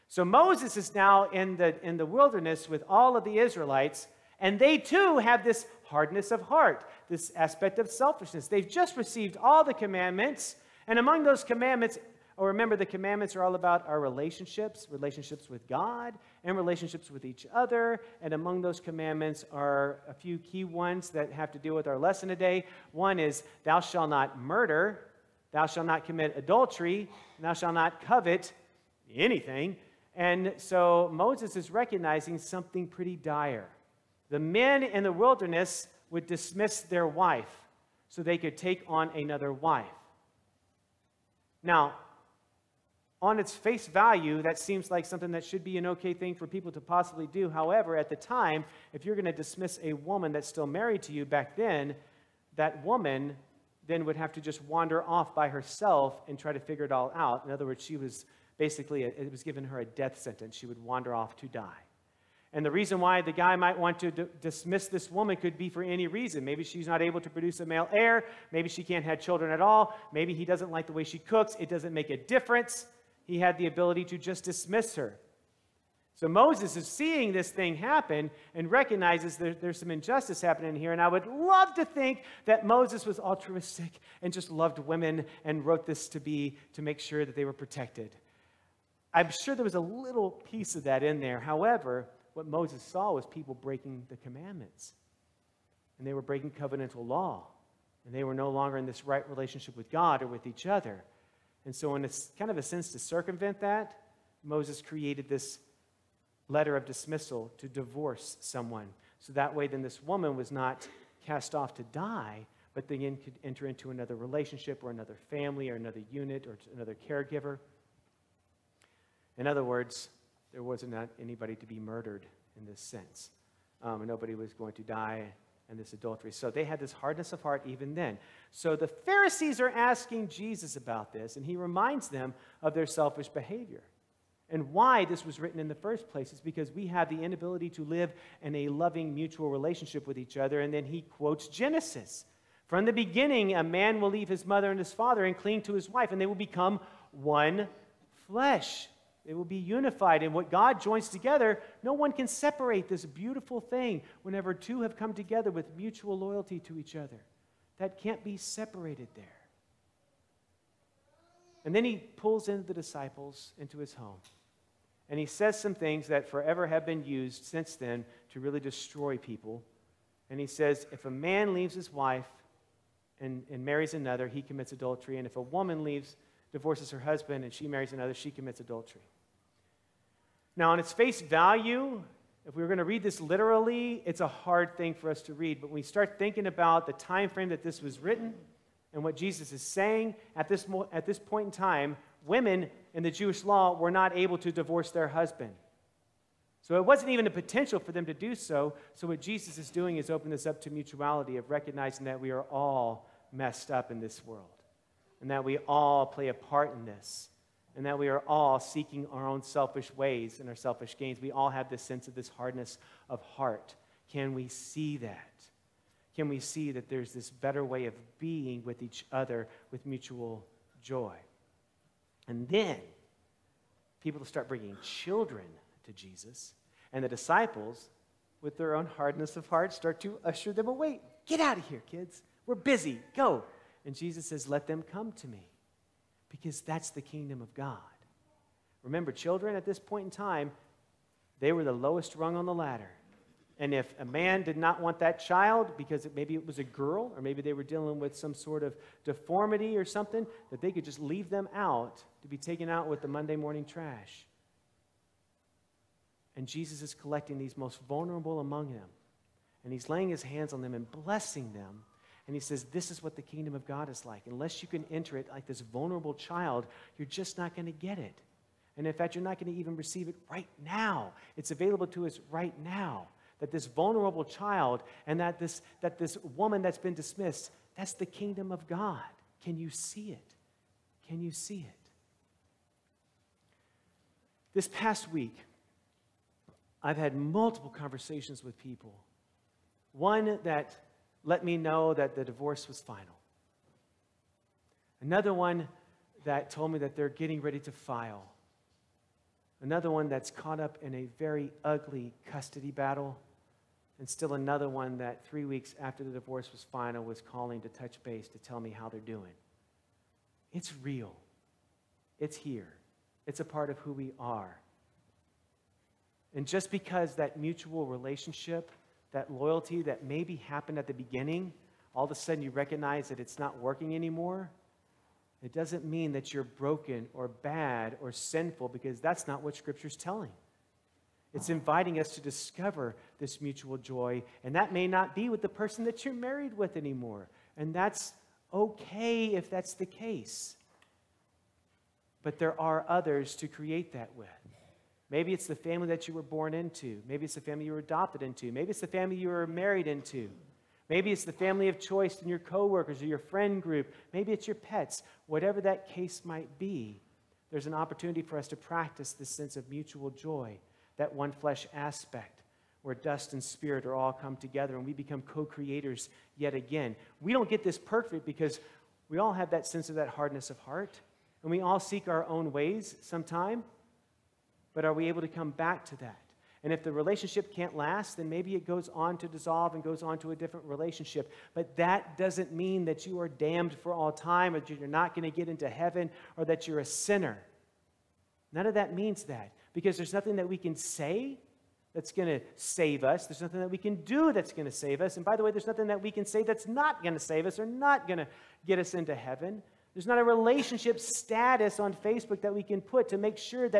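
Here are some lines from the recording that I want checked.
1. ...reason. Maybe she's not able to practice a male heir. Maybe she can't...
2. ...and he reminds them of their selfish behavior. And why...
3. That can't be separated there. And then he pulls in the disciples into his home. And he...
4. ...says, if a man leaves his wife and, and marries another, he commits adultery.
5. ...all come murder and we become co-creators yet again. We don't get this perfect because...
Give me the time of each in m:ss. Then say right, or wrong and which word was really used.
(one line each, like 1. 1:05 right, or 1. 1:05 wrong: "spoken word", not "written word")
1. 1:06 wrong: "produce", not "practice"
2. 2:11 right
3. 2:37 right
4. 2:50 right
5. 6:03 wrong: "together", not "murder".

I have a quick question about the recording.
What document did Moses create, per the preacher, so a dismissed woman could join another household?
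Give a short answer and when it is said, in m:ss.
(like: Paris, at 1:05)
letter of dismissal, at 1:46.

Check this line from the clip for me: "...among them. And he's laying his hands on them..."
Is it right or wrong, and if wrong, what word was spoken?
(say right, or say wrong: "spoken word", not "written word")
right.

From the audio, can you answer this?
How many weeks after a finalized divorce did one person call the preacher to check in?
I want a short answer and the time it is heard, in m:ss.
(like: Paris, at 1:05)
3, at 5:05.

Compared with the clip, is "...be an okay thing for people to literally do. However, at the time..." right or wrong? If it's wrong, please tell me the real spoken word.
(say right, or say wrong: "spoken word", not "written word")
wrong: "possibly", not "literally".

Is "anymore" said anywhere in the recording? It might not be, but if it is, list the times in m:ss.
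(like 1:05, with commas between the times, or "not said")
5:23, 5:36.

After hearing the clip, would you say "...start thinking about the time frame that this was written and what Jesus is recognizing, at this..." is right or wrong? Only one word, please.
wrong.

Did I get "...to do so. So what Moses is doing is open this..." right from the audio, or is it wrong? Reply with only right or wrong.
wrong.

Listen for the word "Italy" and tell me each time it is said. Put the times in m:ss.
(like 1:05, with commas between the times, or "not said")
not said.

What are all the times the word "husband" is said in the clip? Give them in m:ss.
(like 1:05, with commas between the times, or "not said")
2:56, 3:15.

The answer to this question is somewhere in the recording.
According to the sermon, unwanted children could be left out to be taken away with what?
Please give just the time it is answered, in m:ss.
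4:13.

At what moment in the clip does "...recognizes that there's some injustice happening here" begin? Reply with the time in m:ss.
1:18.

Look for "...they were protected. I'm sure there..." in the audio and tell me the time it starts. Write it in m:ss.
1:27.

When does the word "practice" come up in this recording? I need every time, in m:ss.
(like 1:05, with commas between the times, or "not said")
5:58.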